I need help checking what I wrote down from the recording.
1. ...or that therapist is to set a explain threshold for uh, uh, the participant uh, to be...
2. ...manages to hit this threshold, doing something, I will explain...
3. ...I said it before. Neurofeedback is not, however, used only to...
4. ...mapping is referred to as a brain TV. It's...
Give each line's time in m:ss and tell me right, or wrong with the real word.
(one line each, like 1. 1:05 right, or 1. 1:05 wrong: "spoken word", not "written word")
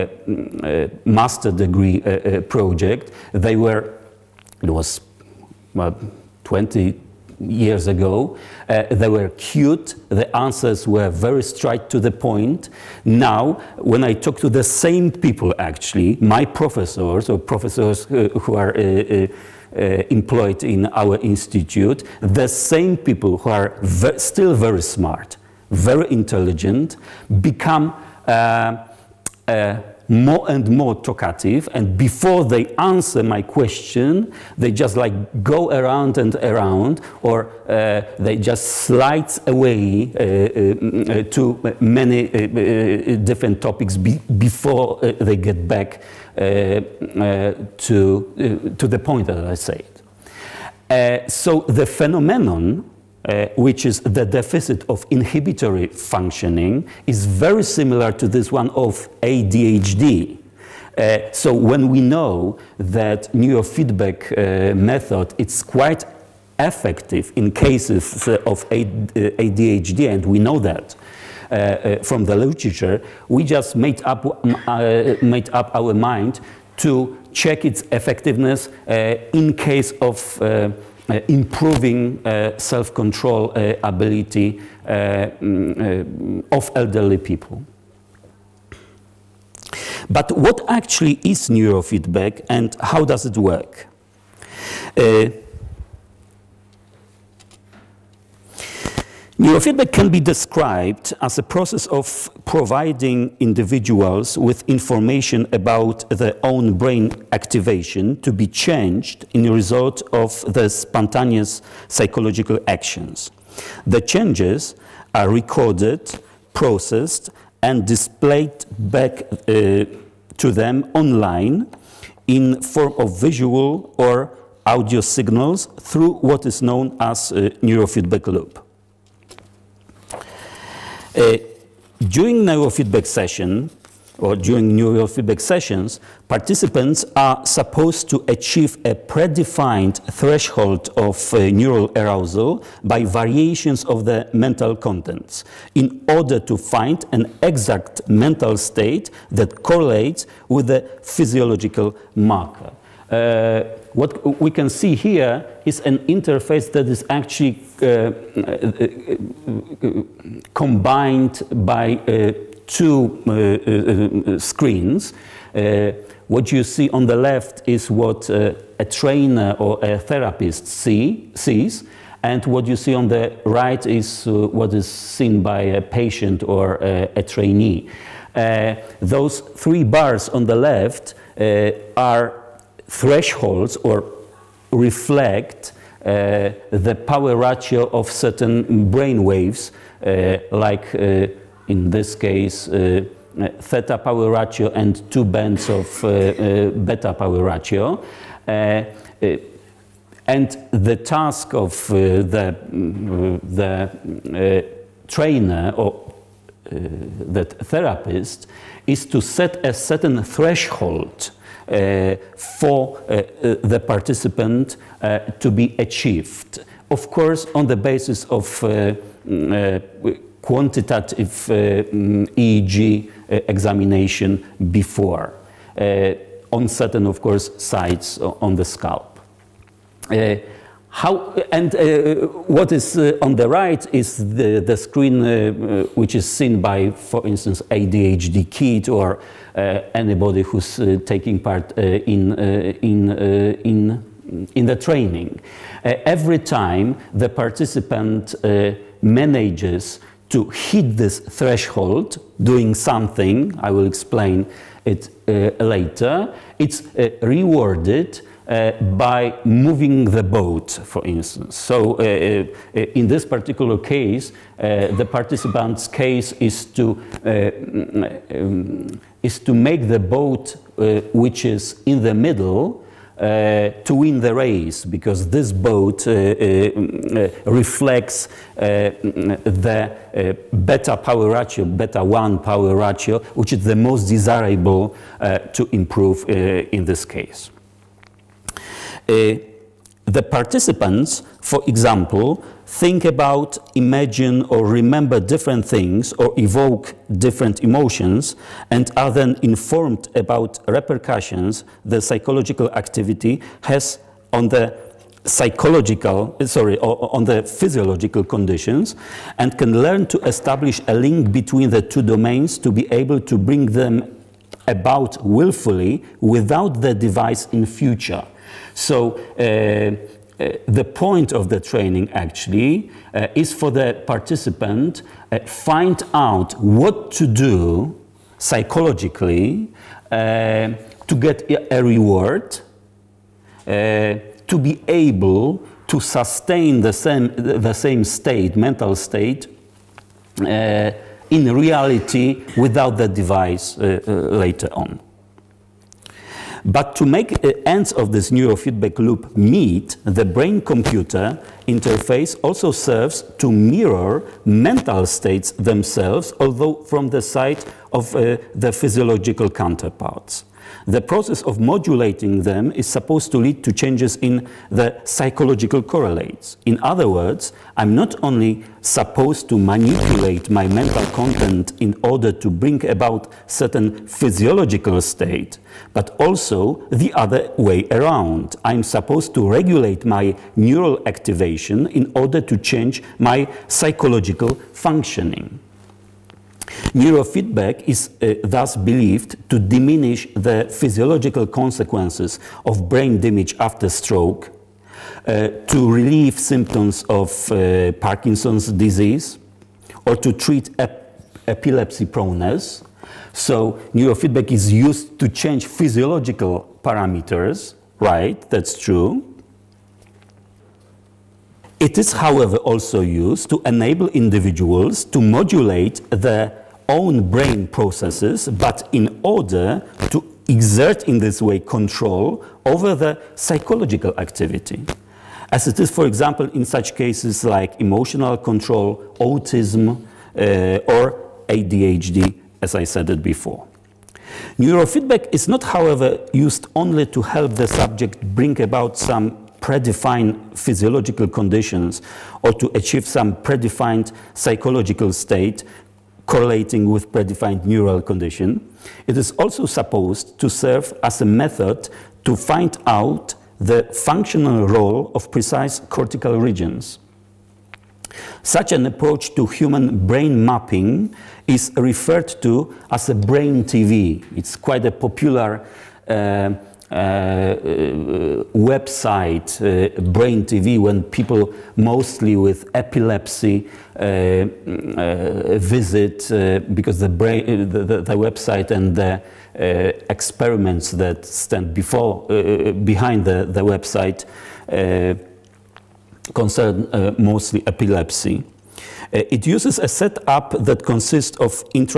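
1. 3:25 wrong: "certain", not "explain"
2. 4:09 right
3. 7:12 right
4. 7:40 right.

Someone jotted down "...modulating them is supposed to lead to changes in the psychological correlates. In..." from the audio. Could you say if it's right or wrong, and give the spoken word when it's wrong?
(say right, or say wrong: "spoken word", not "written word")
right.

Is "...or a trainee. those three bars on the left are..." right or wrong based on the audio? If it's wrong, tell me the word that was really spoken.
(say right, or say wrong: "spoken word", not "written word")
right.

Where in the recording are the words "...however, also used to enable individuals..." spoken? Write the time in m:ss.
6:52.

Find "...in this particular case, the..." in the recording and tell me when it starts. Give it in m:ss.
4:22.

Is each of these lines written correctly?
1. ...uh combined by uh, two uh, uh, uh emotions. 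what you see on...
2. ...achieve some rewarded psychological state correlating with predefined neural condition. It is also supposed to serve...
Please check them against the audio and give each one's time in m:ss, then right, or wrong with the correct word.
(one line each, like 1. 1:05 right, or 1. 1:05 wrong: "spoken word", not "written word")
1. 2:38 wrong: "screens", not "emotions"
2. 7:22 wrong: "predefined", not "rewarded".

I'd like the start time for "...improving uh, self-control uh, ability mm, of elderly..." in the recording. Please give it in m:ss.
1:21.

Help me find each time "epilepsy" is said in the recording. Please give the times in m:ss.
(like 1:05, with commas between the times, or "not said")
6:41, 7:52, 8:07.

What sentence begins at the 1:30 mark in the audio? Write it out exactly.
But what actually is neurofeedback and how does it work?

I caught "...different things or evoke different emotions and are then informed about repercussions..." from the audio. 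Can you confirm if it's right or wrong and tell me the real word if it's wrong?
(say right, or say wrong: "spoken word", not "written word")
right.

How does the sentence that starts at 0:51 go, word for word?
so the phenomenon uh, which is the deficit of inhibitory functioning, is very similar to this one of ADHD.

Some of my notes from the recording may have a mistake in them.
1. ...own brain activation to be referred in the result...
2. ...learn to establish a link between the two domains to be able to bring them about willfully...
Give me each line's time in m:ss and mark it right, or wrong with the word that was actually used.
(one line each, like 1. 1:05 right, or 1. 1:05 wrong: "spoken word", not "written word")
1. 1:46 wrong: "changed", not "referred"
2. 5:09 right.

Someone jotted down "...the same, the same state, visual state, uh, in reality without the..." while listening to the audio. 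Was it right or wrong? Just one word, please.
wrong.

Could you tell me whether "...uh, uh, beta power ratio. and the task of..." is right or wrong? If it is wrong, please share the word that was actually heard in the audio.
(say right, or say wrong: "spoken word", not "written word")
right.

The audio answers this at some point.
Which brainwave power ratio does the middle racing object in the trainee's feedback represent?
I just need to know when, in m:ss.
4:41.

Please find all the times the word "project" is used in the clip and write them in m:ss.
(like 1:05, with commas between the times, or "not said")
0:02.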